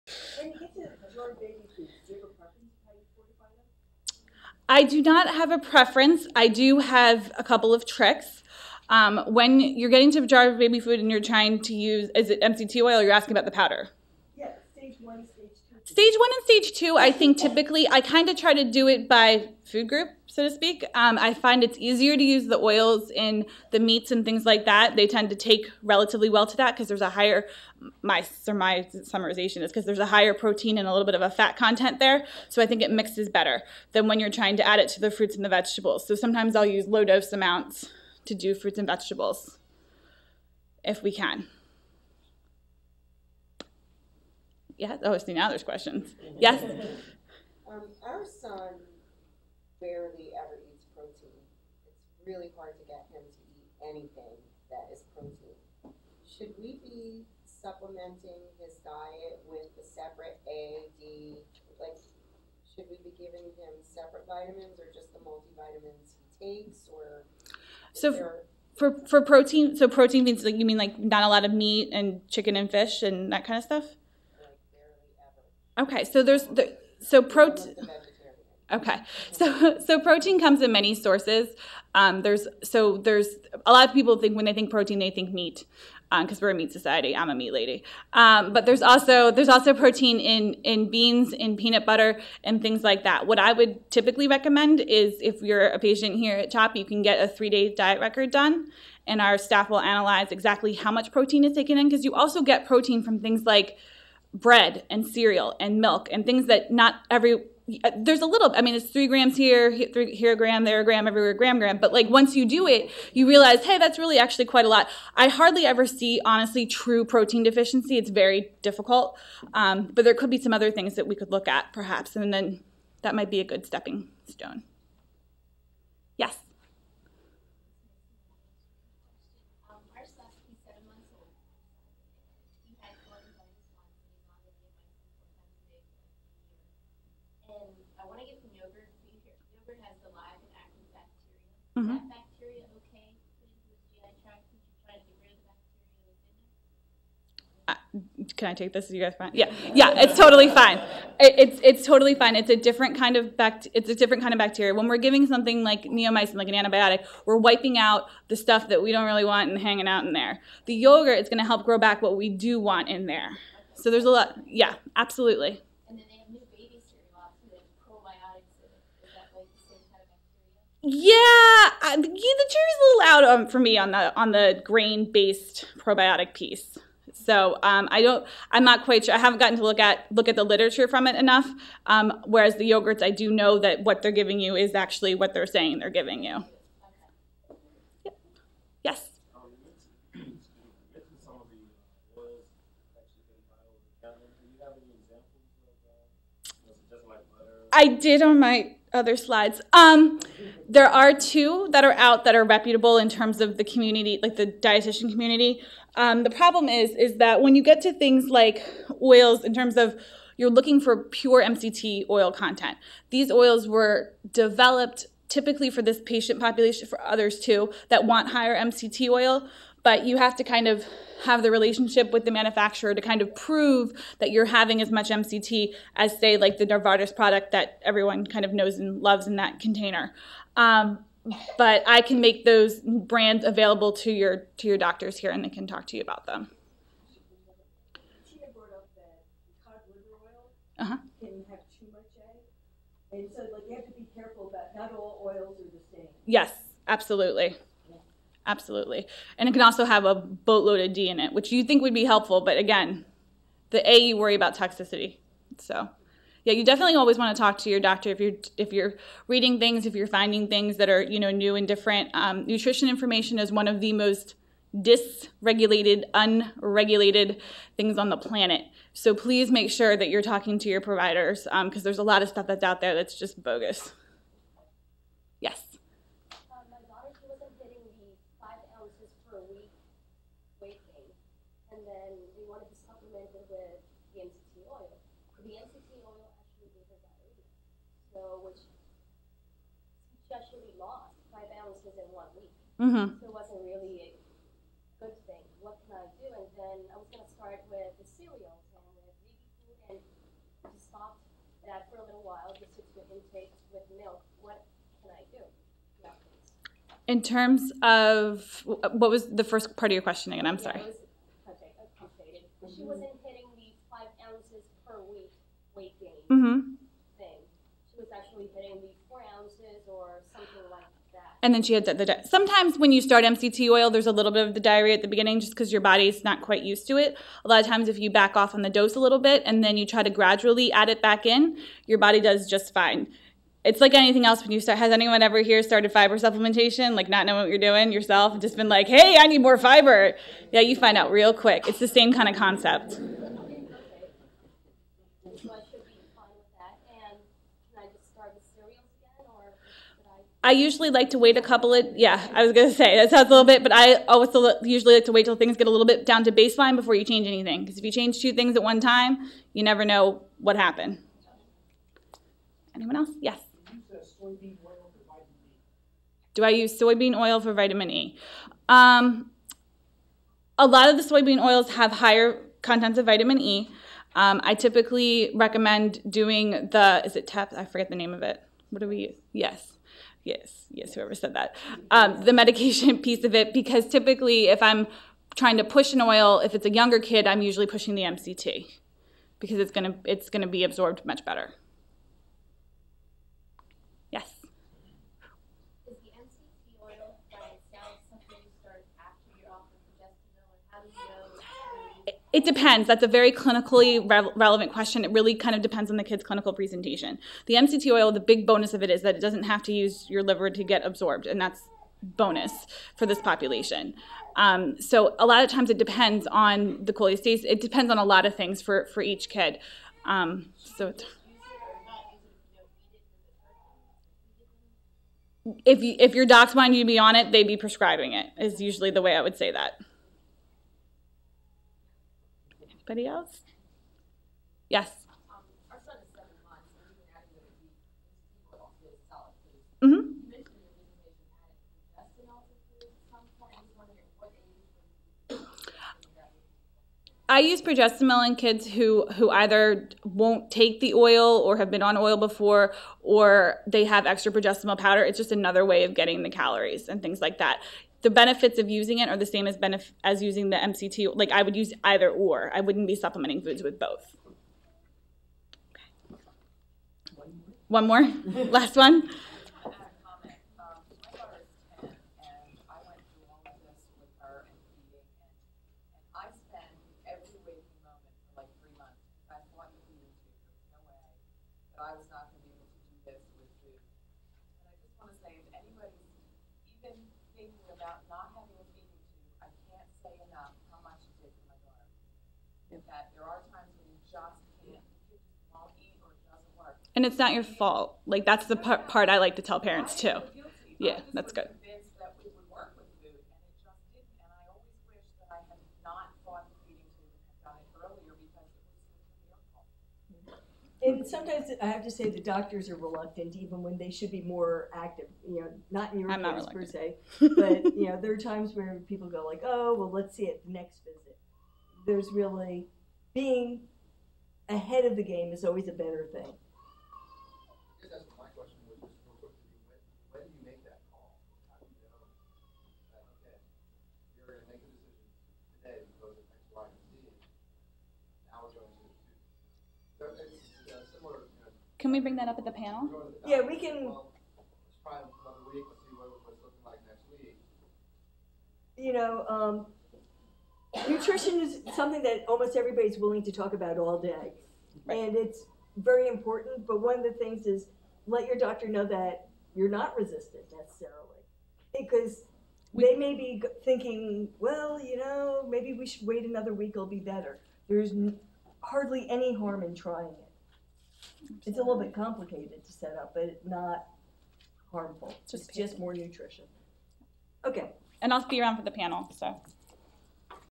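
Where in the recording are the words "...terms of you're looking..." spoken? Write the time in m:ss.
3:29.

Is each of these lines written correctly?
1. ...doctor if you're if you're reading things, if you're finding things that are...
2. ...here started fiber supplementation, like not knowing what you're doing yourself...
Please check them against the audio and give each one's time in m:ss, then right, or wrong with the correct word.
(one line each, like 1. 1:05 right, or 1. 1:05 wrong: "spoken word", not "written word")
1. 4:17 right
2. 5:35 right.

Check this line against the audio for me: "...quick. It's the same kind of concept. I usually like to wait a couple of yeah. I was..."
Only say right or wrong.
right.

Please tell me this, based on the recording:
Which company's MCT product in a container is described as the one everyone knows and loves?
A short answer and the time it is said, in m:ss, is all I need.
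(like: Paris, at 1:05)
Novartis, at 3:46.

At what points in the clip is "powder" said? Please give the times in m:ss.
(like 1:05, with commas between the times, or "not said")
0:13, 7:34.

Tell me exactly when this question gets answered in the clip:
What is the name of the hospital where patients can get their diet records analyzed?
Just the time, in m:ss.
1:36.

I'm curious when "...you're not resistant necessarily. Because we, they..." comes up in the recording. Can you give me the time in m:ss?
9:19.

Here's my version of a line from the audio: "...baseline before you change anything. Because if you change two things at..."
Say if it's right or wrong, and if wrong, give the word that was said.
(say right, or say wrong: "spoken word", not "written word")
right.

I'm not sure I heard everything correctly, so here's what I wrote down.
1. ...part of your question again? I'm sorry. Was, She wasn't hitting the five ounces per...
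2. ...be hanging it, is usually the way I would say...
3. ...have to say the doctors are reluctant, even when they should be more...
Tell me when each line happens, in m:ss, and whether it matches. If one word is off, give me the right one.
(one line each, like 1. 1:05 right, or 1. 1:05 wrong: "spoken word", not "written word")
1. 5:09 right
2. 7:07 wrong: "prescribing", not "hanging"
3. 8:31 right.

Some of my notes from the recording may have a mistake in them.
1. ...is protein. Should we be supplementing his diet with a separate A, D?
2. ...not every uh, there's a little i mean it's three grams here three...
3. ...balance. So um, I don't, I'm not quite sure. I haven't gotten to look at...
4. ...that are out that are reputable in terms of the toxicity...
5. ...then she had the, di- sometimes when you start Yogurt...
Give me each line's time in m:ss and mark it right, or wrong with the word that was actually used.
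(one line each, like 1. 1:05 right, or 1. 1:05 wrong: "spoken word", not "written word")
1. 0:54 right
2. 1:46 right
3. 2:56 wrong: "piece", not "balance"
4. 3:21 wrong: "community", not "toxicity"
5. 5:21 wrong: "MCT", not "Yogurt".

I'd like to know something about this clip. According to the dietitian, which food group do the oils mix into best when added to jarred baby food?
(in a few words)
meats.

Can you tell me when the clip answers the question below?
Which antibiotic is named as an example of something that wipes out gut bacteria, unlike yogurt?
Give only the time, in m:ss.
2:35.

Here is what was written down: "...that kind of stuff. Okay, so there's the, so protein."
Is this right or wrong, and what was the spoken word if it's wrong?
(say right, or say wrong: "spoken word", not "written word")
right.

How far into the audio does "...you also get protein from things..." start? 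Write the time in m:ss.
1:42.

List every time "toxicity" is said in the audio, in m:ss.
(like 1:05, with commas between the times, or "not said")
4:14.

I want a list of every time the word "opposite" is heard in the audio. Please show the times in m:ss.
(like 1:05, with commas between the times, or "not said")
not said.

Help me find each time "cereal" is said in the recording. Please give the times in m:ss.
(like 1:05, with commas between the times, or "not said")
1:45, 4:58.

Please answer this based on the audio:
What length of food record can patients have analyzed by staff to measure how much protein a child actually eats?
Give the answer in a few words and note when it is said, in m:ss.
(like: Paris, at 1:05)
three day, at 1:37.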